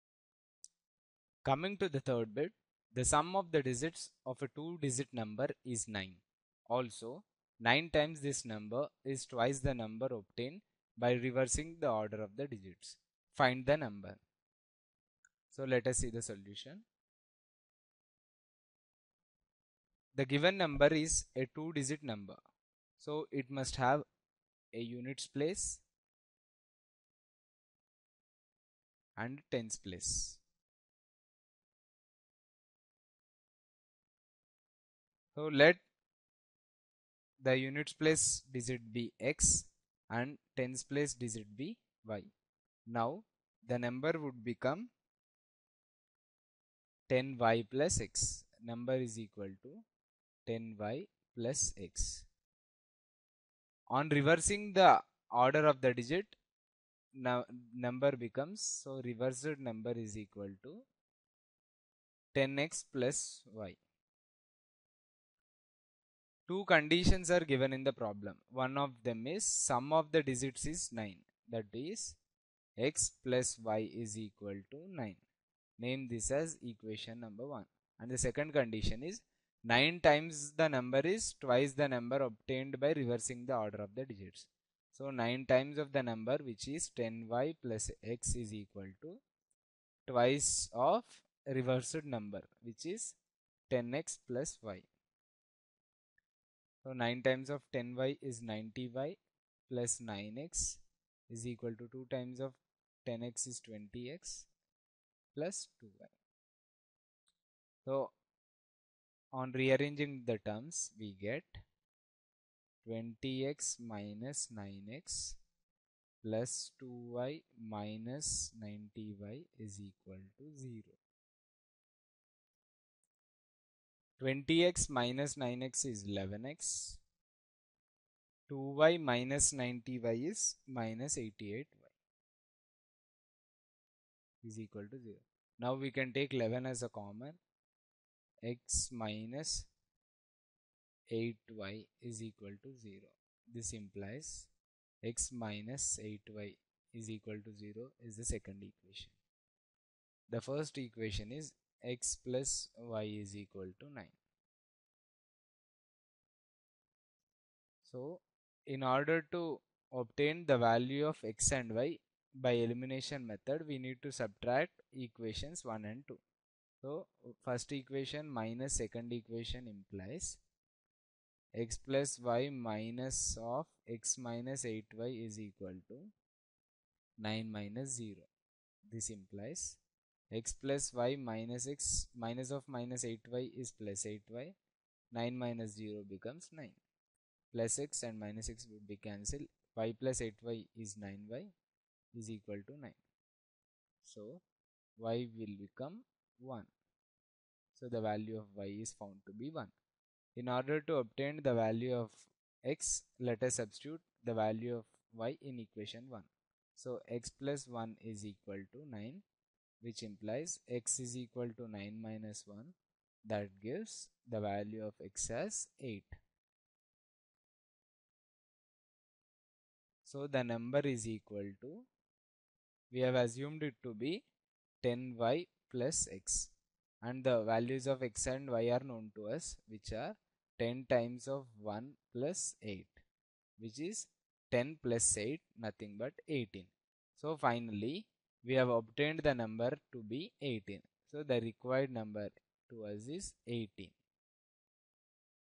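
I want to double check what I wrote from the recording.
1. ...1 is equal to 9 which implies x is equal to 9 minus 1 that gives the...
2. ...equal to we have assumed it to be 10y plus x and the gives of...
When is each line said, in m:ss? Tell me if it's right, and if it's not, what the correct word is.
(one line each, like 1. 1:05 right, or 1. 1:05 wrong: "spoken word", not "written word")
1. 3:27 right
2. 3:41 wrong: "values", not "gives".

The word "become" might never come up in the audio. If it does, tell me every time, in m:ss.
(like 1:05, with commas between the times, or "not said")
0:44, 0:58, 3:06, 3:15.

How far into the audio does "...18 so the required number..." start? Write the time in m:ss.
4:00.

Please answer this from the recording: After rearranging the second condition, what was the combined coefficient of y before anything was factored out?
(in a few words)
-88.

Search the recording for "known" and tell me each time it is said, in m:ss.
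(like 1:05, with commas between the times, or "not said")
3:48.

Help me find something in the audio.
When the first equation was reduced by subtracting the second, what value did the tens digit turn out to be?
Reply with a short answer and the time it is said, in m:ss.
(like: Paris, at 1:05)
1, at 3:14.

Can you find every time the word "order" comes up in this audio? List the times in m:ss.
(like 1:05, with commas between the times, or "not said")
0:11, 0:55, 1:23, 2:38, 3:20.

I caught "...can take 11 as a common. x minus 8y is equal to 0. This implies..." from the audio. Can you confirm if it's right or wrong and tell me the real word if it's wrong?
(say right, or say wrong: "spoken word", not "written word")
right.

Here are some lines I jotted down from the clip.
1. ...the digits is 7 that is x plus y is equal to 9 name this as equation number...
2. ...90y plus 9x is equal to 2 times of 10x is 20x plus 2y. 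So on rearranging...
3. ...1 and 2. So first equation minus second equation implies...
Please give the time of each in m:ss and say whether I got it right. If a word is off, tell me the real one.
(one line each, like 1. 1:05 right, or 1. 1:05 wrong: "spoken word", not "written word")
1. 1:10 wrong: "9", not "7"
2. 1:38 right
3. 2:45 right.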